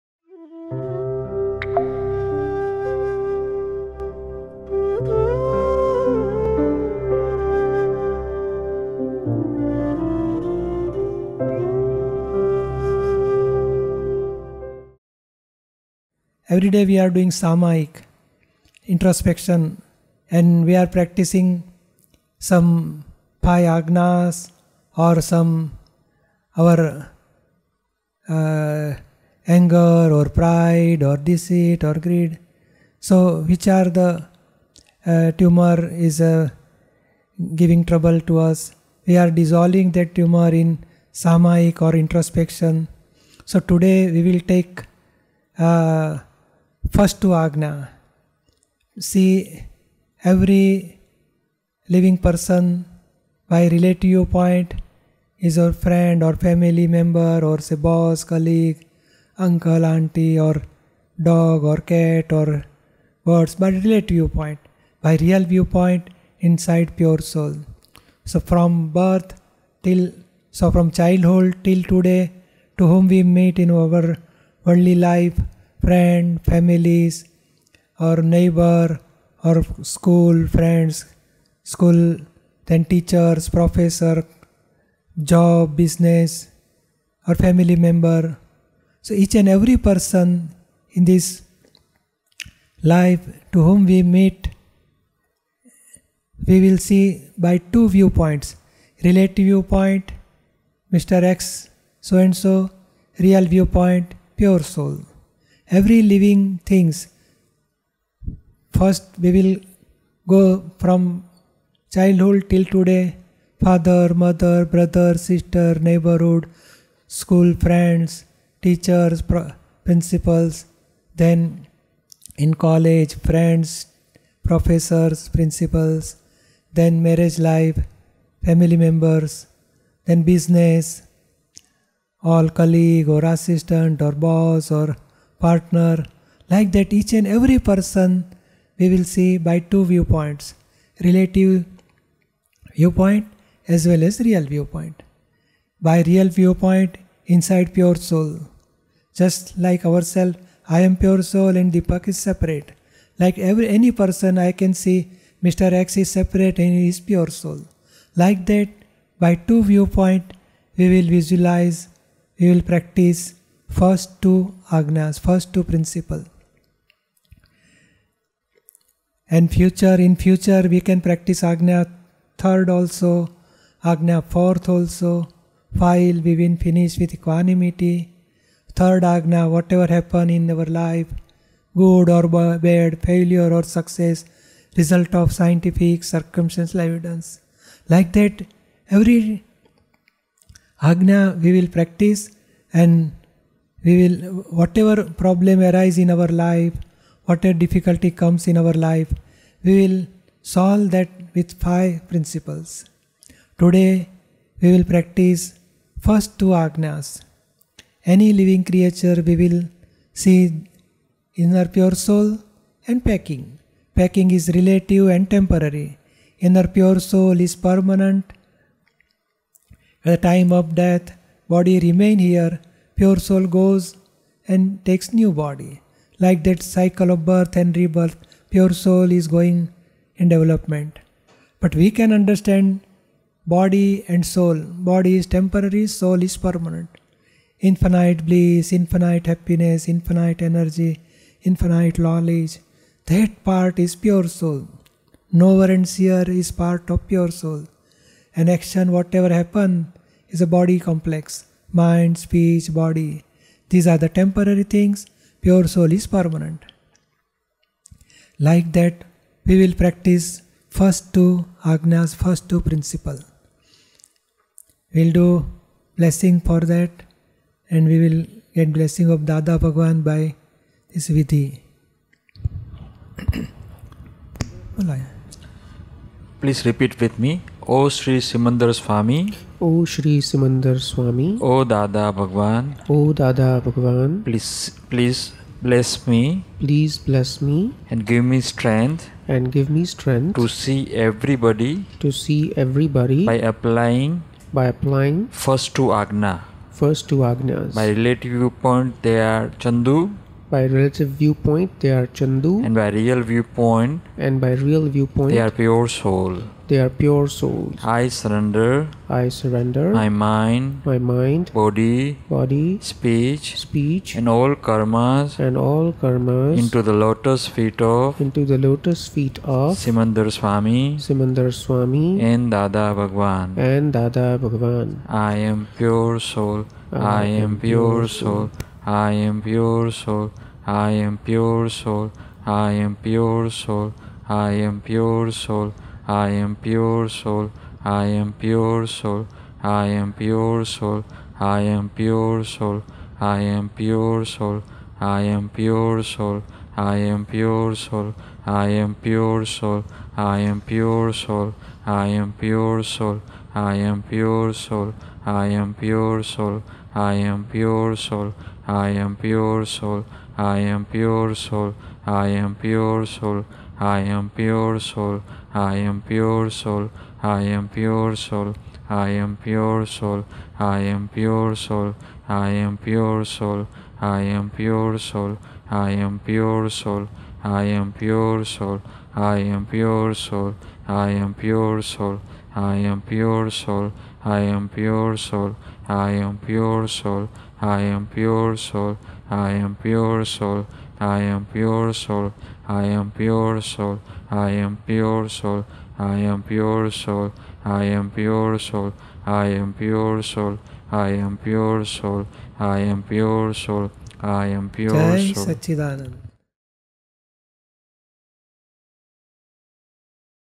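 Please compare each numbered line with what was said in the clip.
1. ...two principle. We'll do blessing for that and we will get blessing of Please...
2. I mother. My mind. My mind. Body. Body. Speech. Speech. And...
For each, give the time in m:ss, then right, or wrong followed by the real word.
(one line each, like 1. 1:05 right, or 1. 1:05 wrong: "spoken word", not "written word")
1. 4:22 wrong: "Dada", not "Please"
2. 5:09 wrong: "surrender", not "mother".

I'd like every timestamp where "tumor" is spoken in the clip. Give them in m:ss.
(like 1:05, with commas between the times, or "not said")
0:35, 0:40.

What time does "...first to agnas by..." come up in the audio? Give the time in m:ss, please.
4:56.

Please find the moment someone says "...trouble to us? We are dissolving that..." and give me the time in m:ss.
0:37.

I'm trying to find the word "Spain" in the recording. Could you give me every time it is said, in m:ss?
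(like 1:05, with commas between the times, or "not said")
not said.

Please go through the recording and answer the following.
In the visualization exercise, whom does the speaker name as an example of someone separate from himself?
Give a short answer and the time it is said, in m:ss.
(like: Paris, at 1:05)
Deepak, at 2:31.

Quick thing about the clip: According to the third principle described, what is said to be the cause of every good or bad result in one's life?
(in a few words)
scientific circumstantial evidence.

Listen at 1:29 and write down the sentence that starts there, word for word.
So each and every person in this life to whom we meet, we will see by two viewpoints relative viewpoint, Mr.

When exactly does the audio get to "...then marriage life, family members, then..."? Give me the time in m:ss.
2:06.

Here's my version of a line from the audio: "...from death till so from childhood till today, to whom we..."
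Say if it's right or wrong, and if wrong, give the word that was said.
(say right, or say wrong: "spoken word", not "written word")
wrong: "birth", not "death".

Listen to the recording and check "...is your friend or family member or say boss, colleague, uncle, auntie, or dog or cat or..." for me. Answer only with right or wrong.
right.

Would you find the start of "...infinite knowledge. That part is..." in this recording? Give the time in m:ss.
4:01.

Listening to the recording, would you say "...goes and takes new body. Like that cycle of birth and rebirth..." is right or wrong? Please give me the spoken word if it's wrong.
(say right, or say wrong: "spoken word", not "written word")
right.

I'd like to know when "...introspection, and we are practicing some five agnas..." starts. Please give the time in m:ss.
0:18.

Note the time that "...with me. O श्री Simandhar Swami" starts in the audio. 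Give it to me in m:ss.
4:36.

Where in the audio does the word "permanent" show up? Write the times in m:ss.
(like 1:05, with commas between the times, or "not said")
3:37, 3:56, 4:16.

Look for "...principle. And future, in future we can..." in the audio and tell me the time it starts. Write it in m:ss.
2:45.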